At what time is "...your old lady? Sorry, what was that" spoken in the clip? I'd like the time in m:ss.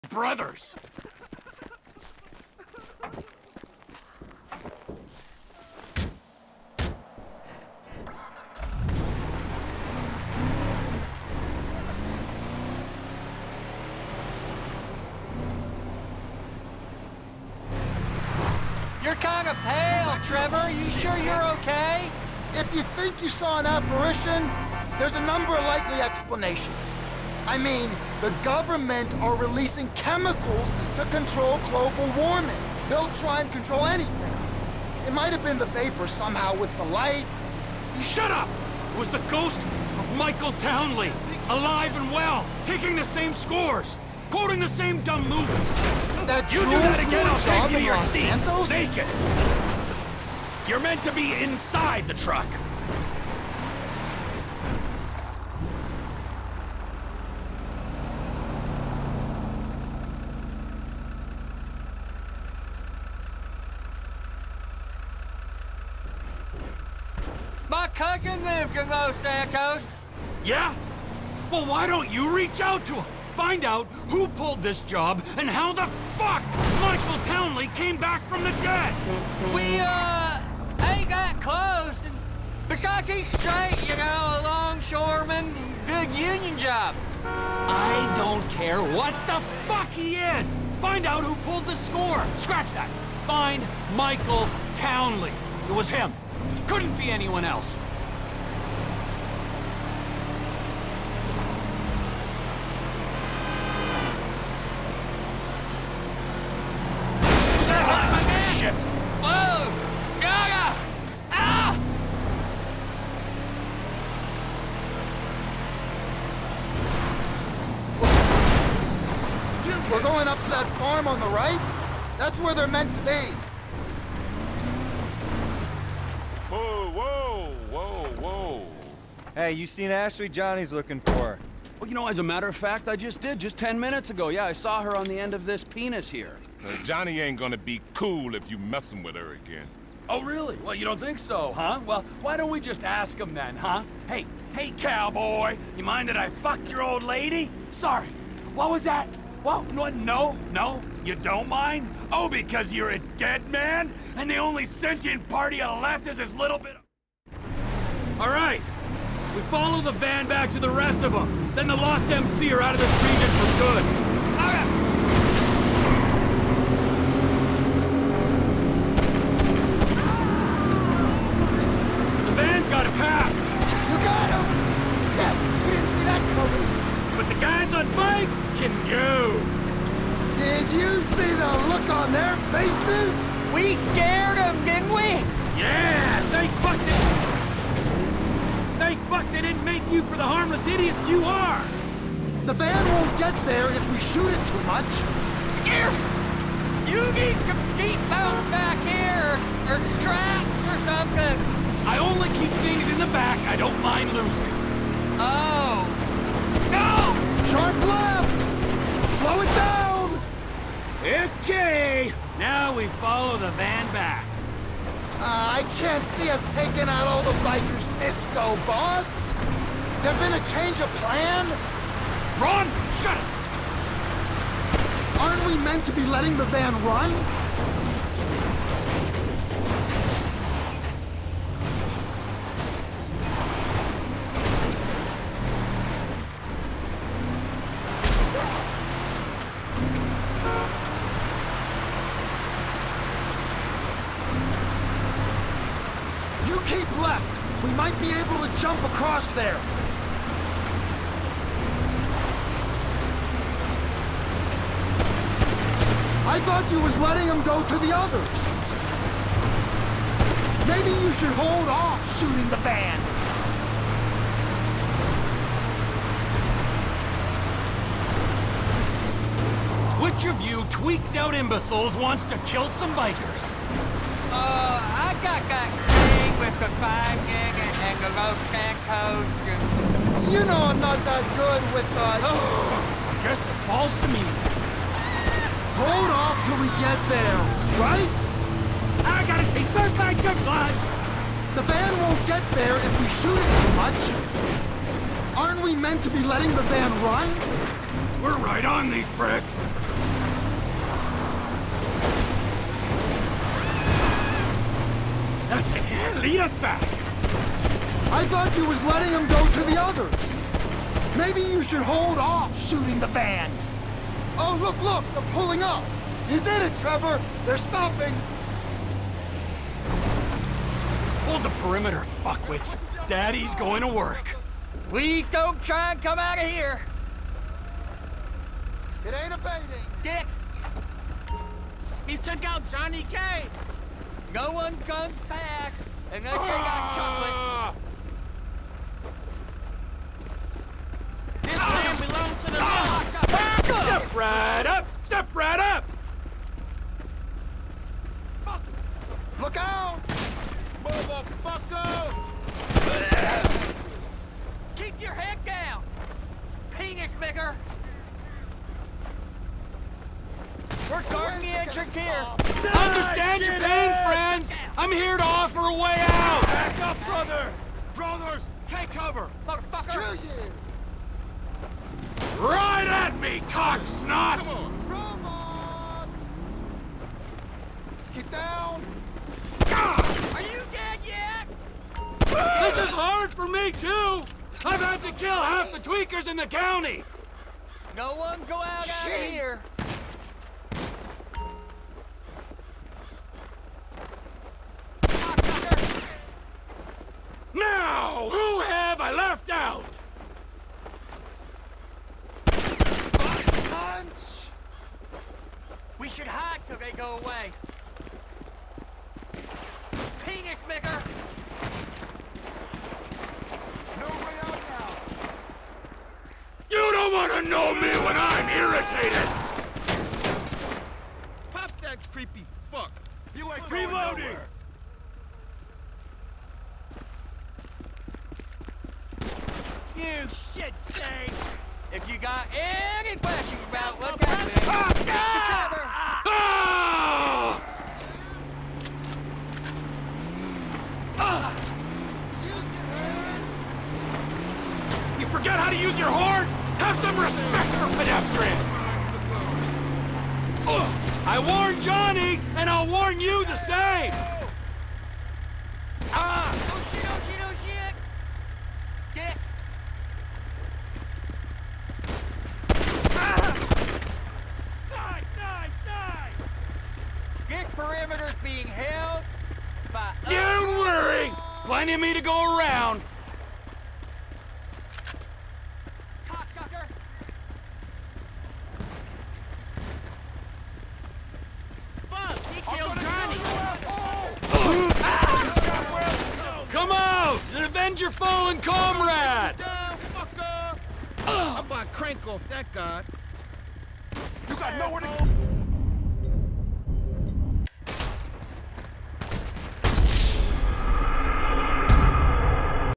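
2:26.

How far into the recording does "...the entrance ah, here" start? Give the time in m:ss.
6:01.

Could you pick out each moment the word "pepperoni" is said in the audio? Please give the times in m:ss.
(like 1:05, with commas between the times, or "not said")
not said.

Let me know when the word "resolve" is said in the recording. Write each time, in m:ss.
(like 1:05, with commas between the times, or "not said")
not said.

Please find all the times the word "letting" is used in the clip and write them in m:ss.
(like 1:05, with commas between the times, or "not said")
3:46, 4:16, 4:56, 5:08.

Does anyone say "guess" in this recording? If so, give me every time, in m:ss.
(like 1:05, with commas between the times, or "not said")
4:43.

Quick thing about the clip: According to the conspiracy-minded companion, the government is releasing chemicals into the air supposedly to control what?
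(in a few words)
global warming.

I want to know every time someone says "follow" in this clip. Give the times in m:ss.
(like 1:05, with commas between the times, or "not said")
2:39, 3:32.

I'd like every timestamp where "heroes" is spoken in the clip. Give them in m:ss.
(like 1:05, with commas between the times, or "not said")
not said.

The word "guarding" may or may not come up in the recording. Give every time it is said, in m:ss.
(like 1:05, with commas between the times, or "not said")
6:01.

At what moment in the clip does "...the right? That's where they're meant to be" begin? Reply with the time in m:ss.
2:01.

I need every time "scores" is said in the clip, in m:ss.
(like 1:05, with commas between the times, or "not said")
0:43, 1:31.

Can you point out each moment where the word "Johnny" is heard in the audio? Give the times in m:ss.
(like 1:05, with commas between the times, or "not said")
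2:10, 2:16, 5:32, 7:31.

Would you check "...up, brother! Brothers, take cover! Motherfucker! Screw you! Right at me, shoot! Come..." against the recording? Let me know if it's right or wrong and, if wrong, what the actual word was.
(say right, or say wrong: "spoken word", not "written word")
wrong: "cocksnot", not "shoot".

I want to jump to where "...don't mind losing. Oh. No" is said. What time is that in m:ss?
3:23.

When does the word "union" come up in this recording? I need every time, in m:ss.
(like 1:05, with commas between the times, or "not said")
1:26.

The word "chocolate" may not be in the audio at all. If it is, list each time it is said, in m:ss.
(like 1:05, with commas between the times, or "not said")
5:36.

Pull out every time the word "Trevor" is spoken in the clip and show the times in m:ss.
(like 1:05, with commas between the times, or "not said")
0:20, 5:16.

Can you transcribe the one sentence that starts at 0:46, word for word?
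That you do that again, I'll take you to your seat, naked.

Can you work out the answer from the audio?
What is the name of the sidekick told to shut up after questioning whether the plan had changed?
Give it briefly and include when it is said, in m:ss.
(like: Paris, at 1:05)
Ron, at 3:42.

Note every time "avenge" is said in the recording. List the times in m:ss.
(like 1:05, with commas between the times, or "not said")
8:07.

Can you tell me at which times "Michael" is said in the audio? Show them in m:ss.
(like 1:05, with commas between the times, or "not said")
0:40, 1:16, 1:33.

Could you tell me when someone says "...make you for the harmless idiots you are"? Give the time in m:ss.
3:09.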